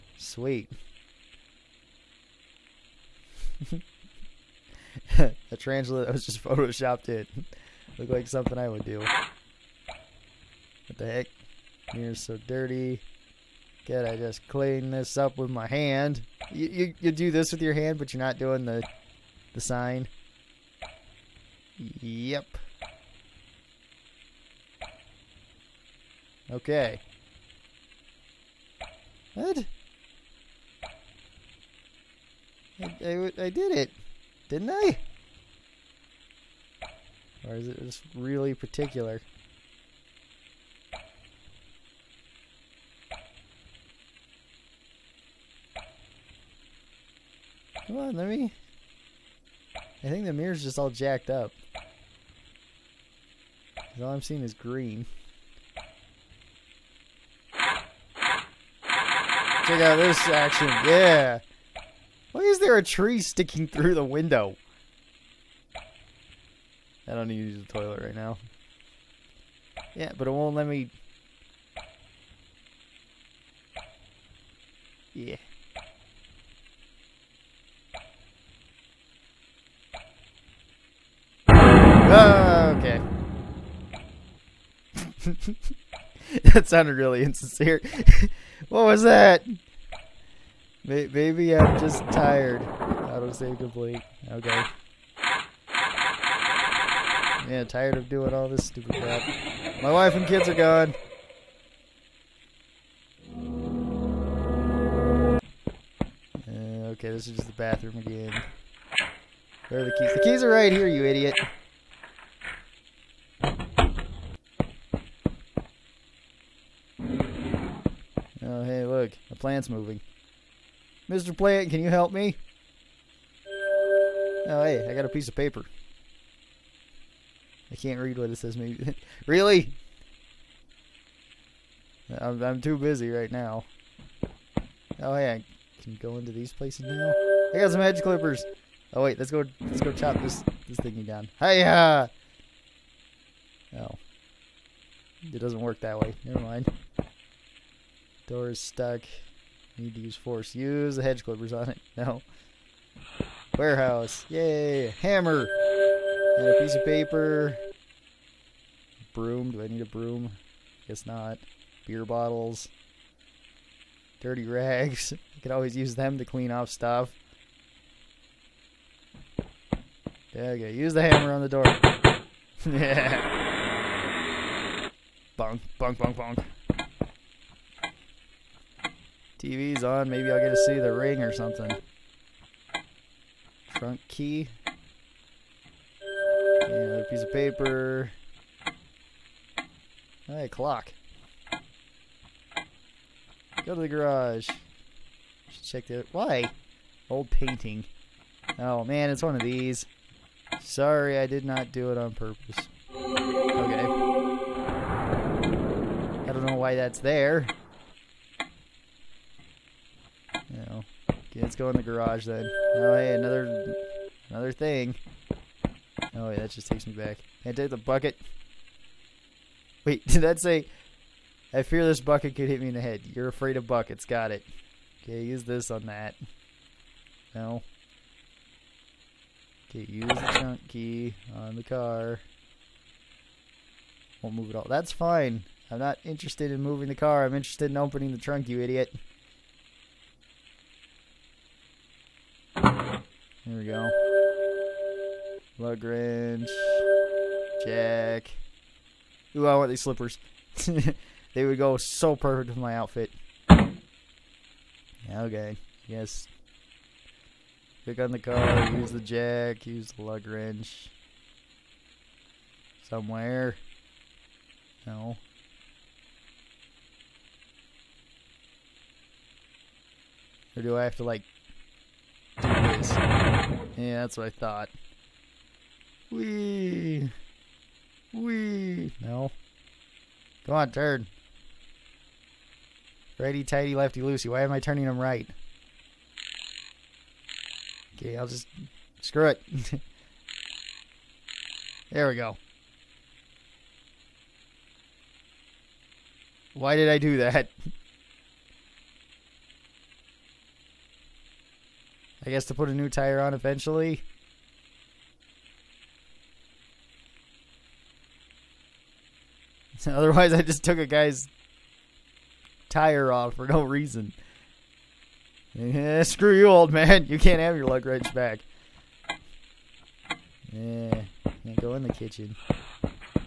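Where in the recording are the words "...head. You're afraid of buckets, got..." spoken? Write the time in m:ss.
3:42.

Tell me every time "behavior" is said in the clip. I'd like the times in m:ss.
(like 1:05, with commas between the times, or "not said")
not said.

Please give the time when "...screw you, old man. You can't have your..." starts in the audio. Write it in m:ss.
5:16.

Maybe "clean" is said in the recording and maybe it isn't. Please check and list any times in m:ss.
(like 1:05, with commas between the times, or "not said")
0:14, 2:46.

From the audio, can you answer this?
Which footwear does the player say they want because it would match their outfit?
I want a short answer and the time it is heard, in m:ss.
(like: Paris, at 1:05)
Slippers, at 4:09.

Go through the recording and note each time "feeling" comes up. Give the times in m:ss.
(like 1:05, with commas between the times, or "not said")
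not said.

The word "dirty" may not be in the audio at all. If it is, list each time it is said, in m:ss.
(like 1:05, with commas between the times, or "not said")
0:12, 2:44.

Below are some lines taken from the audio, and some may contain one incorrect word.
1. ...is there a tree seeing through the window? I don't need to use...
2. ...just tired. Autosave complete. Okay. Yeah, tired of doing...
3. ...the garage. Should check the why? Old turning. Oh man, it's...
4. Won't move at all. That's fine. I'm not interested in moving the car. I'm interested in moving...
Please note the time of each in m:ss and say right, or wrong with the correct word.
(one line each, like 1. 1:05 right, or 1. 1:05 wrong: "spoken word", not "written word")
1. 1:02 wrong: "sticking", not "seeing"
2. 1:31 right
3. 3:13 wrong: "painting", not "turning"
4. 3:54 wrong: "opening", not "moving".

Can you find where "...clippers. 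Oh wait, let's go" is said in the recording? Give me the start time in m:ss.
2:18.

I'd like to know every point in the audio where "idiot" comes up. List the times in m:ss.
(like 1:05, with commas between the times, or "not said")
1:51, 3:58.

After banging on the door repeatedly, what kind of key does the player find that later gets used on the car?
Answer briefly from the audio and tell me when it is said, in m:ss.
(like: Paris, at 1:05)
Trunk key, at 3:03.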